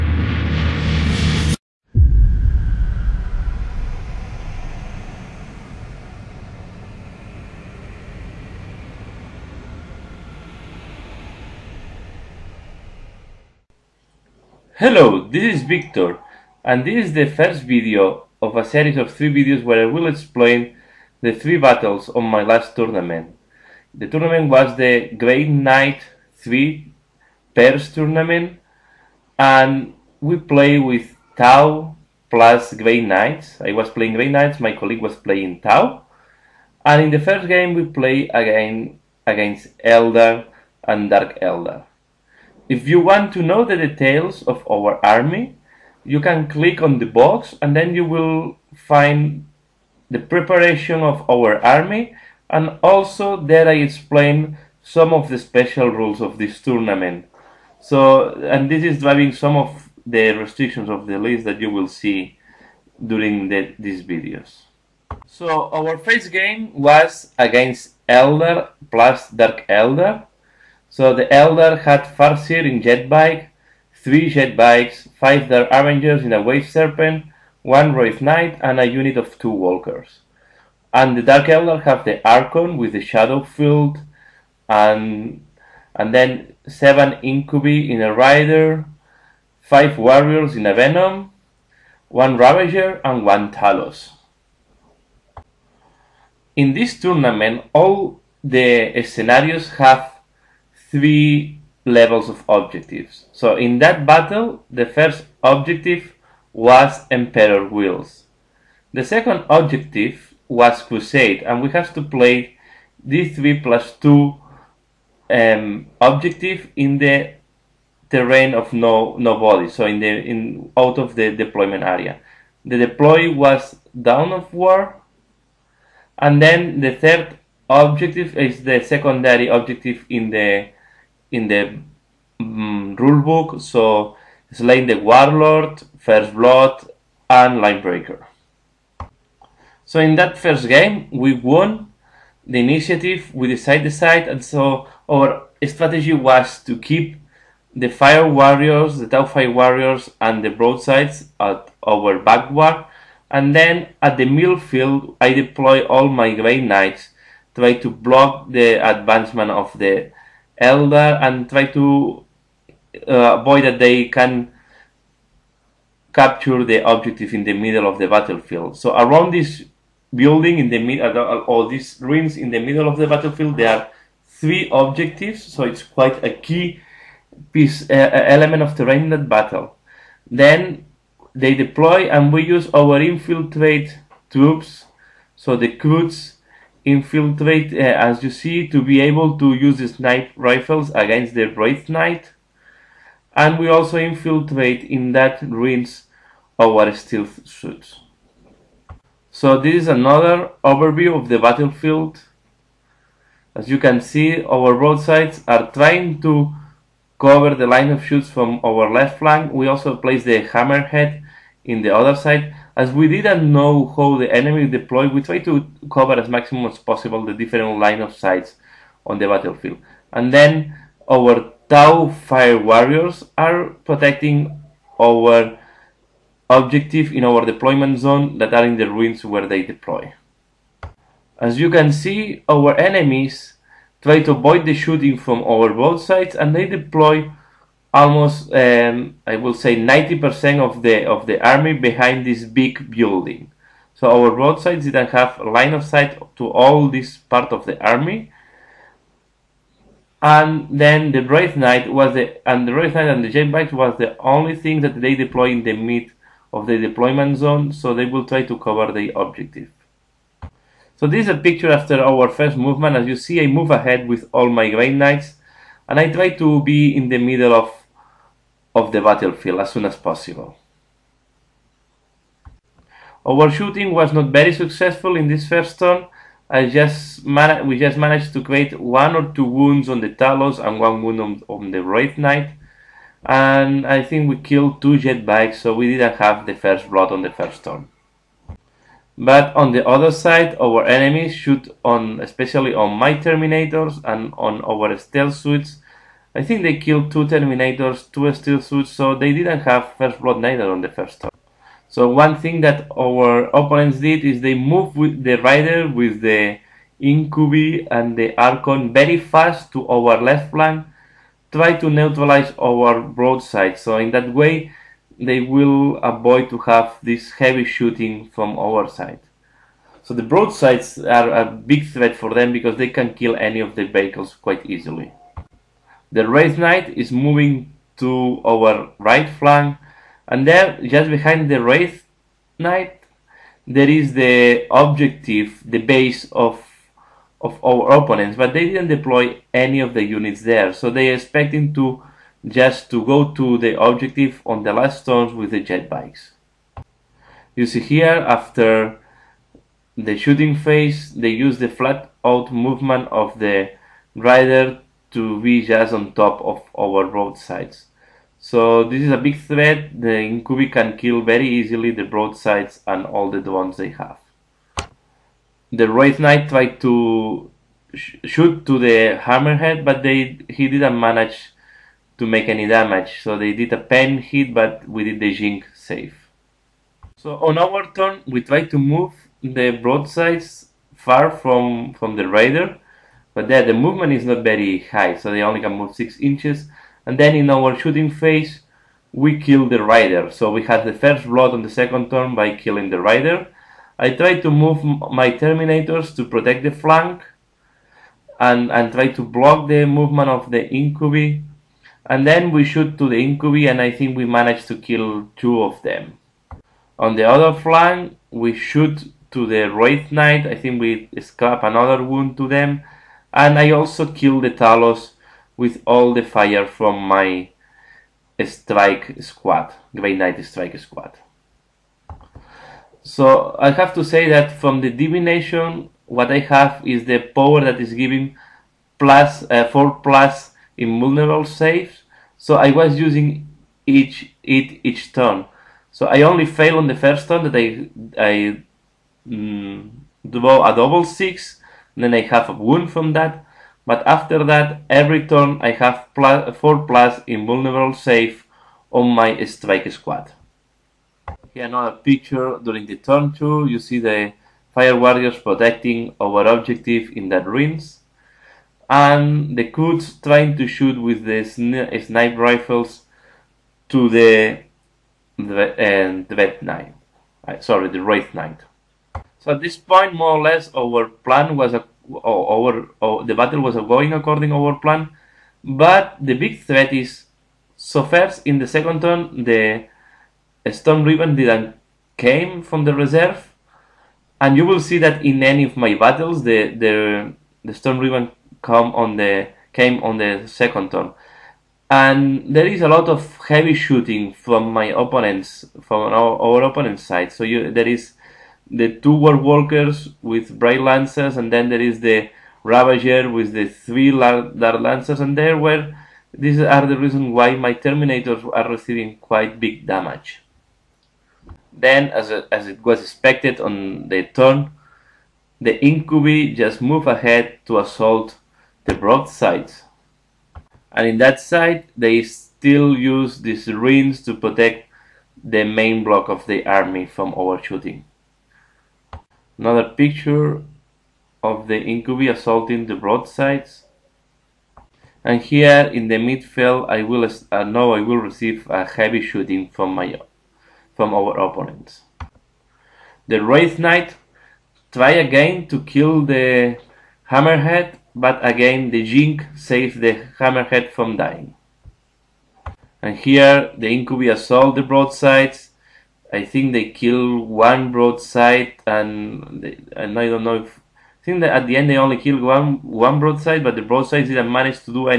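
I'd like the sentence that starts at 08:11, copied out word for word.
And there is a lot of heavy shooting from my opponents, from our, our opponent's side.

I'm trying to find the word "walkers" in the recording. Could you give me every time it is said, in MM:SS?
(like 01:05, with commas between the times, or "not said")
01:19, 08:19.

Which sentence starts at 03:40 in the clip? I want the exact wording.
And then our Tau Fire Warriors are protecting our objective in our deployment zone that are in the ruins where they deploy.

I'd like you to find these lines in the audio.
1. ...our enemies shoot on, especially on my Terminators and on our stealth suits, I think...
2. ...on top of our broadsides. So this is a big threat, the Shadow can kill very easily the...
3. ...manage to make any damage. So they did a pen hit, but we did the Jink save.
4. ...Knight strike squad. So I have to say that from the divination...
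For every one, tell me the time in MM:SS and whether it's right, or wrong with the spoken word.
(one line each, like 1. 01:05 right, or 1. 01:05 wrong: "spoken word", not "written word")
1. 04:50 right
2. 05:55 wrong: "Incubi", not "Shadow"
3. 06:10 right
4. 07:00 right.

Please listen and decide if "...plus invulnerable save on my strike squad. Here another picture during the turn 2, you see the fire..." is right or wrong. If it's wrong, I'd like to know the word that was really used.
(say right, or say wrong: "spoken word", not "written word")
right.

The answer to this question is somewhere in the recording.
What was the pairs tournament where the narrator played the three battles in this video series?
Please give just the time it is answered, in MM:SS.
00:25.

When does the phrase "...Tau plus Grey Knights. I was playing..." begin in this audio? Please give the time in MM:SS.
00:31.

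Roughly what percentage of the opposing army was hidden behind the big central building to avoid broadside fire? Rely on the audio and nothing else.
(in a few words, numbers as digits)
90%.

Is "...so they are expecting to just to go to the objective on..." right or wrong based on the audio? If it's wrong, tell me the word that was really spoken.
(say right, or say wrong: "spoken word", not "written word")
right.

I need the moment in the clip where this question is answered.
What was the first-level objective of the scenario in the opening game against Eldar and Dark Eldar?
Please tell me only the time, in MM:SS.
01:47.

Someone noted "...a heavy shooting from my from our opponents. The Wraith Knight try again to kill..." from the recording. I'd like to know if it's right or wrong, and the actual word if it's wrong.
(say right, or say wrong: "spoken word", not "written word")
right.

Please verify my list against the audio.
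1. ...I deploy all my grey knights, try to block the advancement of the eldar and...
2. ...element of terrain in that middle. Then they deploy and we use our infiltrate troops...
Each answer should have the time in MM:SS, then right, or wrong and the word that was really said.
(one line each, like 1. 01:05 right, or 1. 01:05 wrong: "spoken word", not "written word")
1. 02:35 right
2. 02:58 wrong: "battle", not "middle".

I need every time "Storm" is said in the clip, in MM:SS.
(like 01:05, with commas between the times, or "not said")
08:00, 08:07.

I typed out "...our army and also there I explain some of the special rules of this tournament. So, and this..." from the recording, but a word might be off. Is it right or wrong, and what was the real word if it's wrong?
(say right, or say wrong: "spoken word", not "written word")
right.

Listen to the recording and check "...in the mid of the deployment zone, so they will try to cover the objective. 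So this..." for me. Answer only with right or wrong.
right.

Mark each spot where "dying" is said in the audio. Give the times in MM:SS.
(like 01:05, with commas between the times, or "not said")
09:11.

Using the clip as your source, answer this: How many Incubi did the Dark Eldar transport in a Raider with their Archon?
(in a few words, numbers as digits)
7.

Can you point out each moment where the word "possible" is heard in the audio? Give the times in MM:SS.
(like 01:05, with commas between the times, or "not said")
03:36, 04:29.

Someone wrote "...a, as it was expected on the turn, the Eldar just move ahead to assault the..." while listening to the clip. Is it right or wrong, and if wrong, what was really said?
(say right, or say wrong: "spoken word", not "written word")
wrong: "Incubi", not "Eldar".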